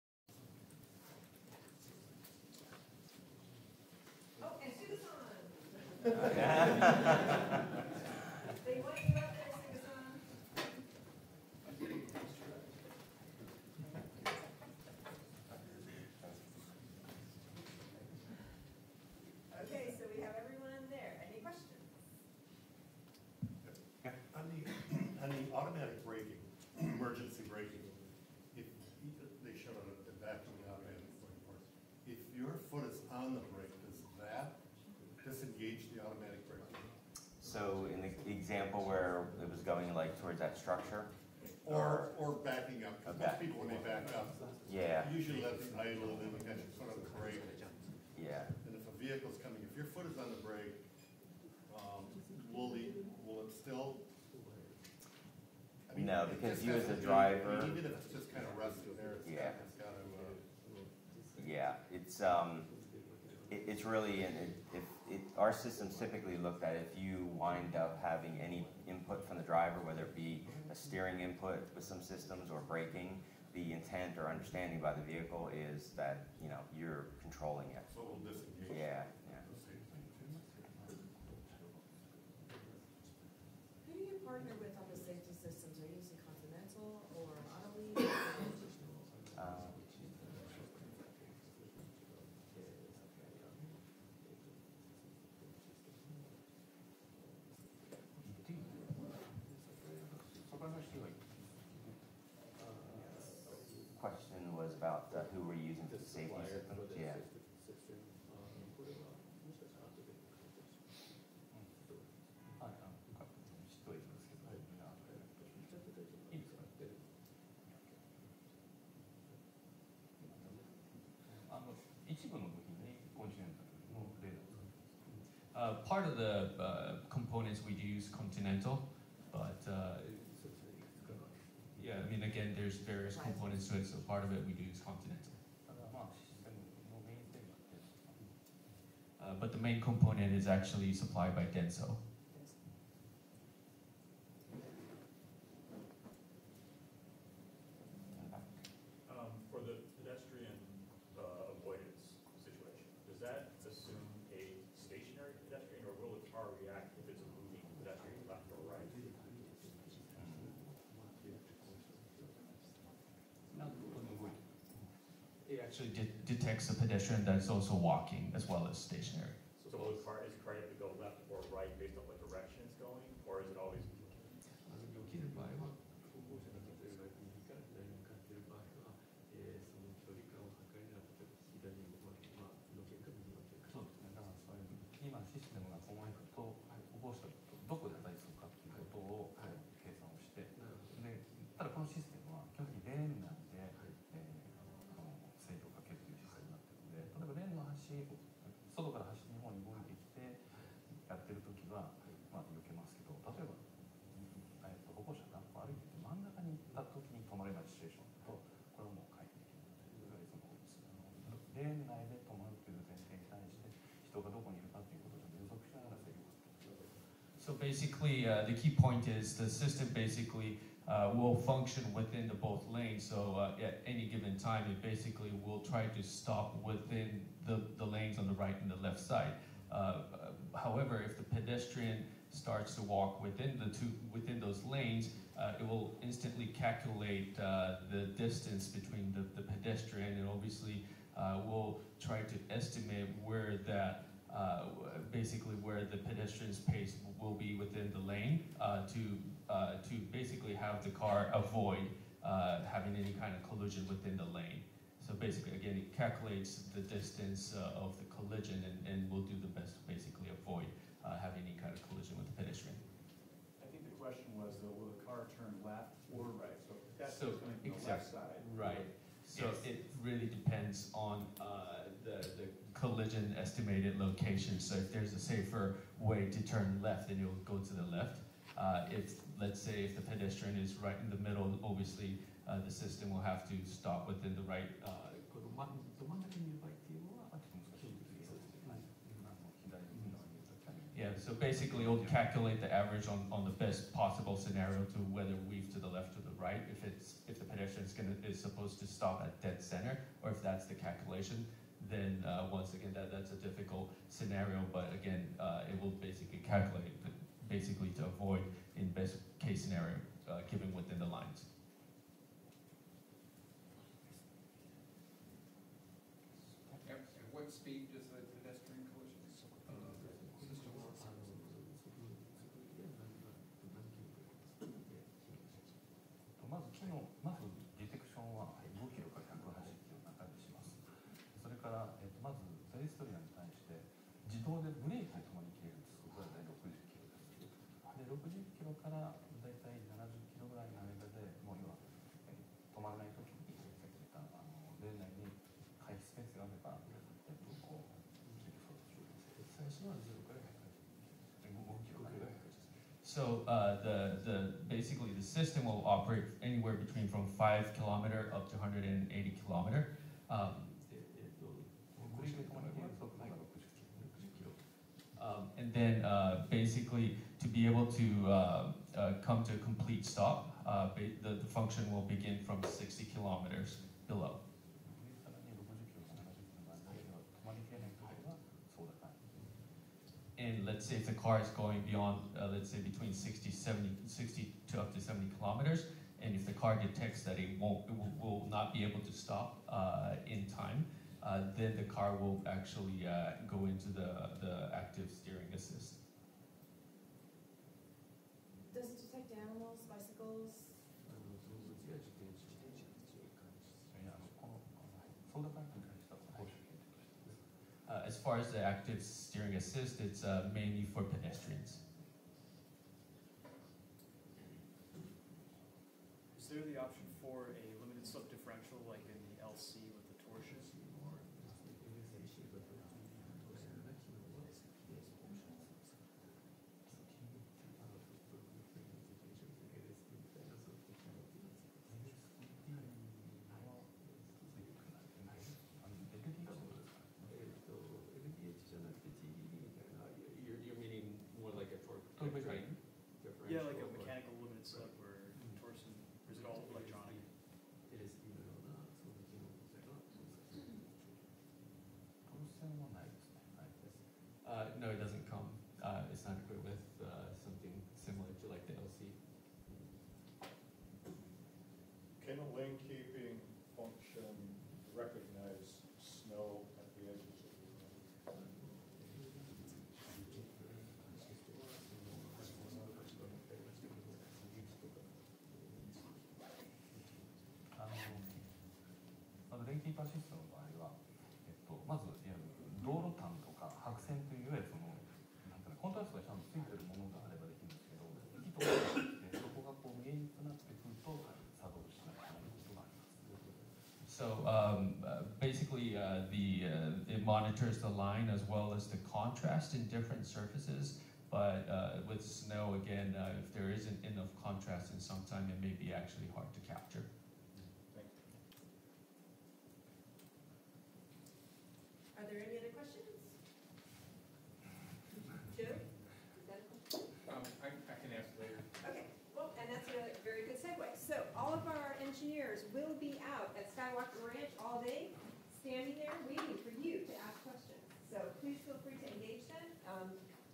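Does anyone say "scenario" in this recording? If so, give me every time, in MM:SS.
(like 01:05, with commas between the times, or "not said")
04:54, 05:04, 05:09.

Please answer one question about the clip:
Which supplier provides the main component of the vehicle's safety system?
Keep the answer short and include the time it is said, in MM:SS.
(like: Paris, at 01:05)
Denso, at 02:21.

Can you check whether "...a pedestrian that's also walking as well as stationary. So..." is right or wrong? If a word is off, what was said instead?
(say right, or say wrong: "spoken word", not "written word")
right.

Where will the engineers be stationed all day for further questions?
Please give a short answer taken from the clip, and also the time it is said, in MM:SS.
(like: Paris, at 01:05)
Skywalker Ranch, at 08:43.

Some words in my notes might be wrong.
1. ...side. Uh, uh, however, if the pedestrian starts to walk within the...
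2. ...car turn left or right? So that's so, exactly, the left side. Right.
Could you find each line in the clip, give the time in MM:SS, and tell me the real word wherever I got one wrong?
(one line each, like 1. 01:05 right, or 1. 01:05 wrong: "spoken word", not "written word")
1. 03:49 right
2. 04:25 right.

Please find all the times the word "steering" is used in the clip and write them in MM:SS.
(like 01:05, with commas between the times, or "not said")
01:10, 06:35, 06:49.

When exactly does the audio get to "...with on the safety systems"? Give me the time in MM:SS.
01:24.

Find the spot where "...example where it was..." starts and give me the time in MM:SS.
00:38.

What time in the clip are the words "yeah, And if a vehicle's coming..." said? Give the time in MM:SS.
00:48.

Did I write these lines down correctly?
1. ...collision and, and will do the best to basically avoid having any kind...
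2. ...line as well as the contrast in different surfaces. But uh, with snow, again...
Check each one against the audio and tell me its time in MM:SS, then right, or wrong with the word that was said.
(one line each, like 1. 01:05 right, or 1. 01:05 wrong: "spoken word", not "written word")
1. 04:18 right
2. 08:17 right.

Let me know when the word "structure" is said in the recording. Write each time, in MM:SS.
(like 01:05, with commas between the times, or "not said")
00:40.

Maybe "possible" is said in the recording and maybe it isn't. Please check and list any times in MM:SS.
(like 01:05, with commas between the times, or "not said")
04:53.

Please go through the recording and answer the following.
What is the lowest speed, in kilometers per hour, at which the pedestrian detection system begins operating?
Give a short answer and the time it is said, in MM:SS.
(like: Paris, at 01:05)
5, at 05:57.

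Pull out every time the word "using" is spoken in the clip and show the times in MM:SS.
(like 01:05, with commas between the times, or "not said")
01:25, 01:45.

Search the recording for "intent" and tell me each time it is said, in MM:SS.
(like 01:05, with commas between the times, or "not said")
01:13.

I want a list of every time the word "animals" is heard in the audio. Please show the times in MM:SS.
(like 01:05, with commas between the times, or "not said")
06:39.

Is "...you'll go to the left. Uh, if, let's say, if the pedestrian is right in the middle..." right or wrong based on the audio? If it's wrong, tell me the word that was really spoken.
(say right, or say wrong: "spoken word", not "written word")
right.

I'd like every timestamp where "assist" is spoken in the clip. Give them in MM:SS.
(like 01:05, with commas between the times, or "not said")
06:35, 06:49.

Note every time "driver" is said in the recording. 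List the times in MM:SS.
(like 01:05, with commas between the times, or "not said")
00:57, 01:09.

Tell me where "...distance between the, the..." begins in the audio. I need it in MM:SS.
03:58.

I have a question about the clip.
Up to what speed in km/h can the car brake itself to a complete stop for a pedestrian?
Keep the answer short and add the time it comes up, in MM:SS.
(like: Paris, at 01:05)
60, at 06:12.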